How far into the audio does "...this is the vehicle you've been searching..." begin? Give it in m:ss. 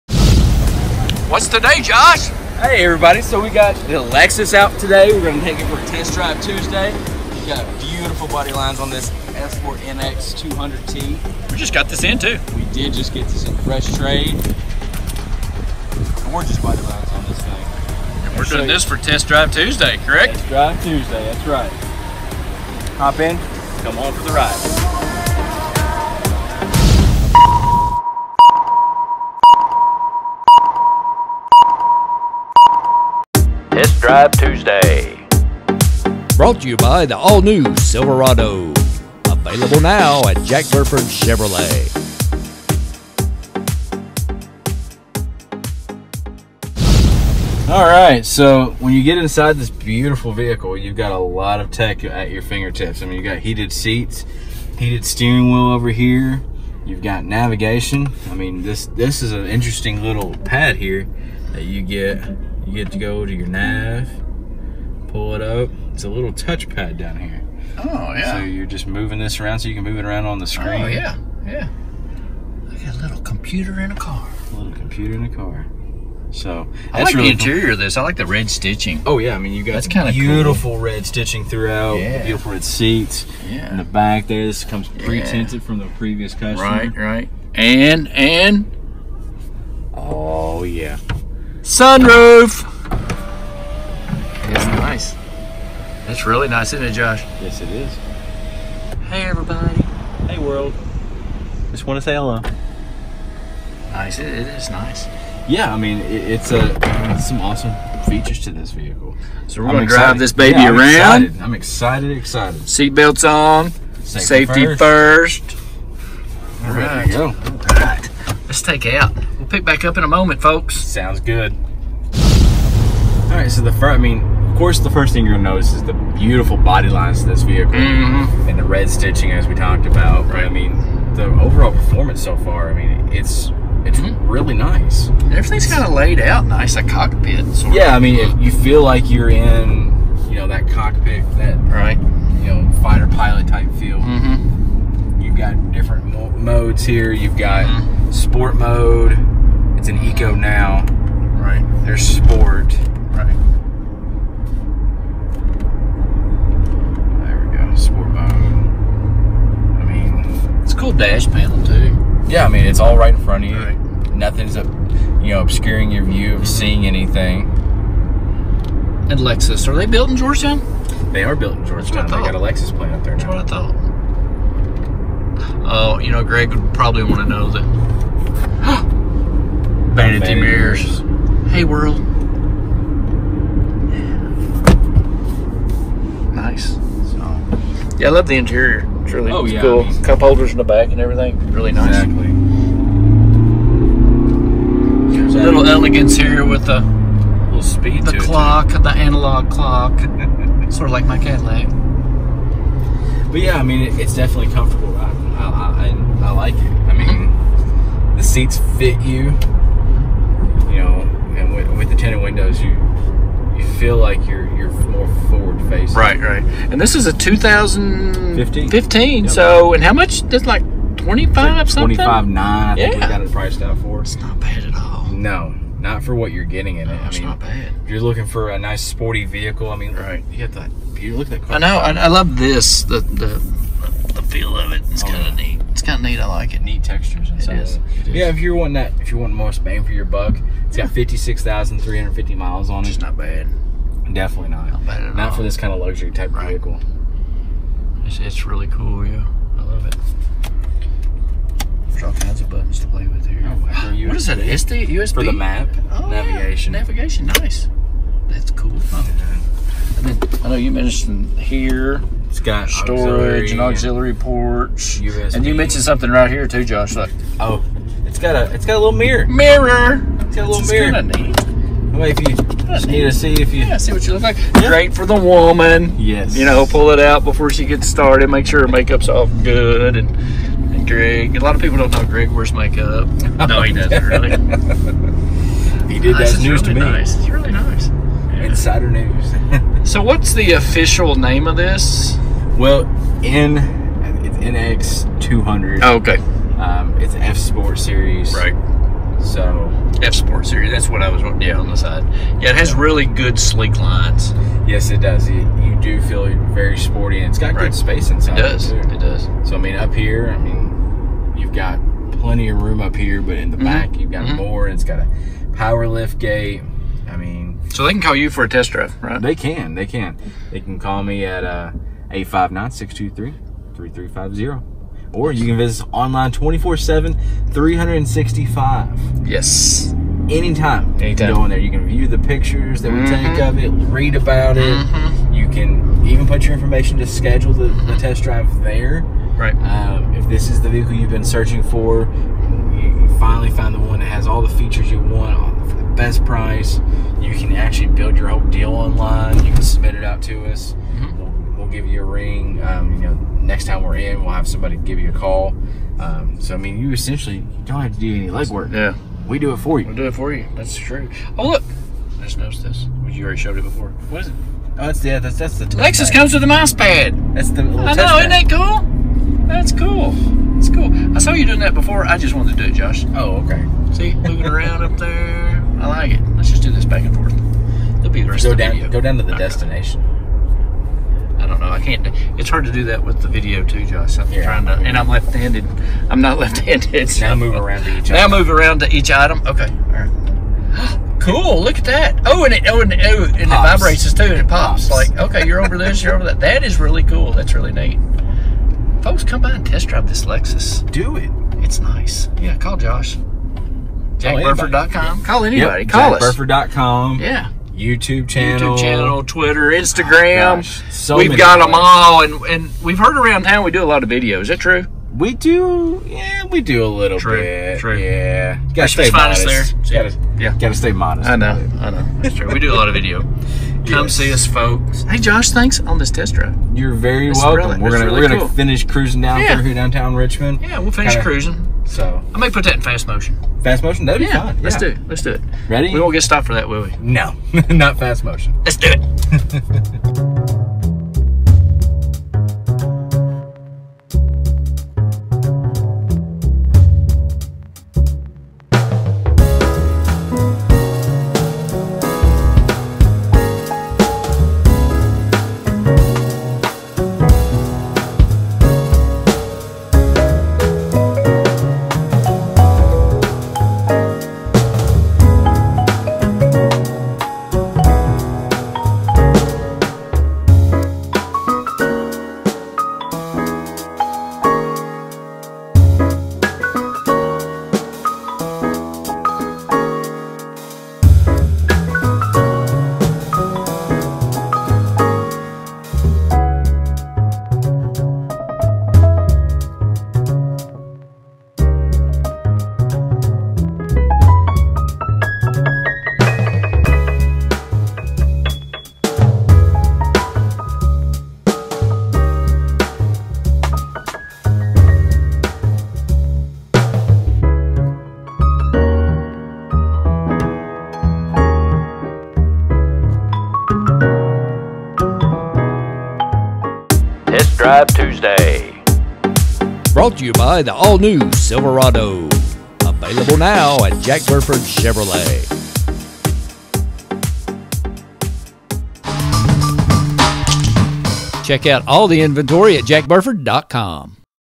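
5:40.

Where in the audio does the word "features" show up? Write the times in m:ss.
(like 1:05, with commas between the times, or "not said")
1:48, 5:44.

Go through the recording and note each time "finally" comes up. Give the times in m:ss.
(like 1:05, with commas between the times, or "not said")
5:43.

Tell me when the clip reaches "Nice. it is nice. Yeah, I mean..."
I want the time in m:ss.
1:43.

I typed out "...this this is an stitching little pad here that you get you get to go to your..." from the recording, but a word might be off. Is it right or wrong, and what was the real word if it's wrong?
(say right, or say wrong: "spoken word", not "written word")
wrong: "interesting", not "stitching".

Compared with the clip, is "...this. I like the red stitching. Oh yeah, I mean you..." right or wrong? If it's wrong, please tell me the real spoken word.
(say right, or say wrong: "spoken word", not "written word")
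right.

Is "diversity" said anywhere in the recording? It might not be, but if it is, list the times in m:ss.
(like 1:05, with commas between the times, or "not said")
not said.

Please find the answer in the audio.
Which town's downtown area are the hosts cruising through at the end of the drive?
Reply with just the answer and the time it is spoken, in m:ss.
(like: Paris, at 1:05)
Richmond, at 7:10.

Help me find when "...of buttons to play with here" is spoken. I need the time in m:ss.
4:12.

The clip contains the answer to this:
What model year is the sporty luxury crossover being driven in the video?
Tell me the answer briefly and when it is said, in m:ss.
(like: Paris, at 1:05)
2015, at 3:36.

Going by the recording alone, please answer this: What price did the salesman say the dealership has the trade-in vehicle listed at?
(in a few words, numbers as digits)
$25,900.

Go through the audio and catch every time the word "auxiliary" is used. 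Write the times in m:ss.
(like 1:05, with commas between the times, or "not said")
4:23.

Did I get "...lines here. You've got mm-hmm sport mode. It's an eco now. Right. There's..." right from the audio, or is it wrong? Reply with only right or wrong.
wrong.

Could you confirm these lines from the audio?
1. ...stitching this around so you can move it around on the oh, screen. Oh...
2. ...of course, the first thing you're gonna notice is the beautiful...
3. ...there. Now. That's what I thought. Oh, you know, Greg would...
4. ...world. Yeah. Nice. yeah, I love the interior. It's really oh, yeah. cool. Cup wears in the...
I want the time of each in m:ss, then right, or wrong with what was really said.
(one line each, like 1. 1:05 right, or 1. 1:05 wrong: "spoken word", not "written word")
1. 1:08 wrong: "moving", not "stitching"
2. 2:04 right
3. 2:53 right
4. 3:01 wrong: "holders", not "wears".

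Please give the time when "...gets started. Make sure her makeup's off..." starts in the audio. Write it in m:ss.
4:37.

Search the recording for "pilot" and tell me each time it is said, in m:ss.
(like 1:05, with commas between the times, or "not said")
2:23.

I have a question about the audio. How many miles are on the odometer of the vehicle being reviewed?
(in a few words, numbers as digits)
56,350.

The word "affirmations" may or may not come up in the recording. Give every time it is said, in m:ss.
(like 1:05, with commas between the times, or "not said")
not said.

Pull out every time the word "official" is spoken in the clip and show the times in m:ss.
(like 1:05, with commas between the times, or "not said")
4:50.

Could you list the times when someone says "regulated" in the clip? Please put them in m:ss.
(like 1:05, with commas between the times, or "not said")
not said.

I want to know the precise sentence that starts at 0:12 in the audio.
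We did just get this in fresh trade.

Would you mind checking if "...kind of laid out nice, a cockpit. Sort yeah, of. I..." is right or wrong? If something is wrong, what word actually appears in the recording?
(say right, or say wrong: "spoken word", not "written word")
right.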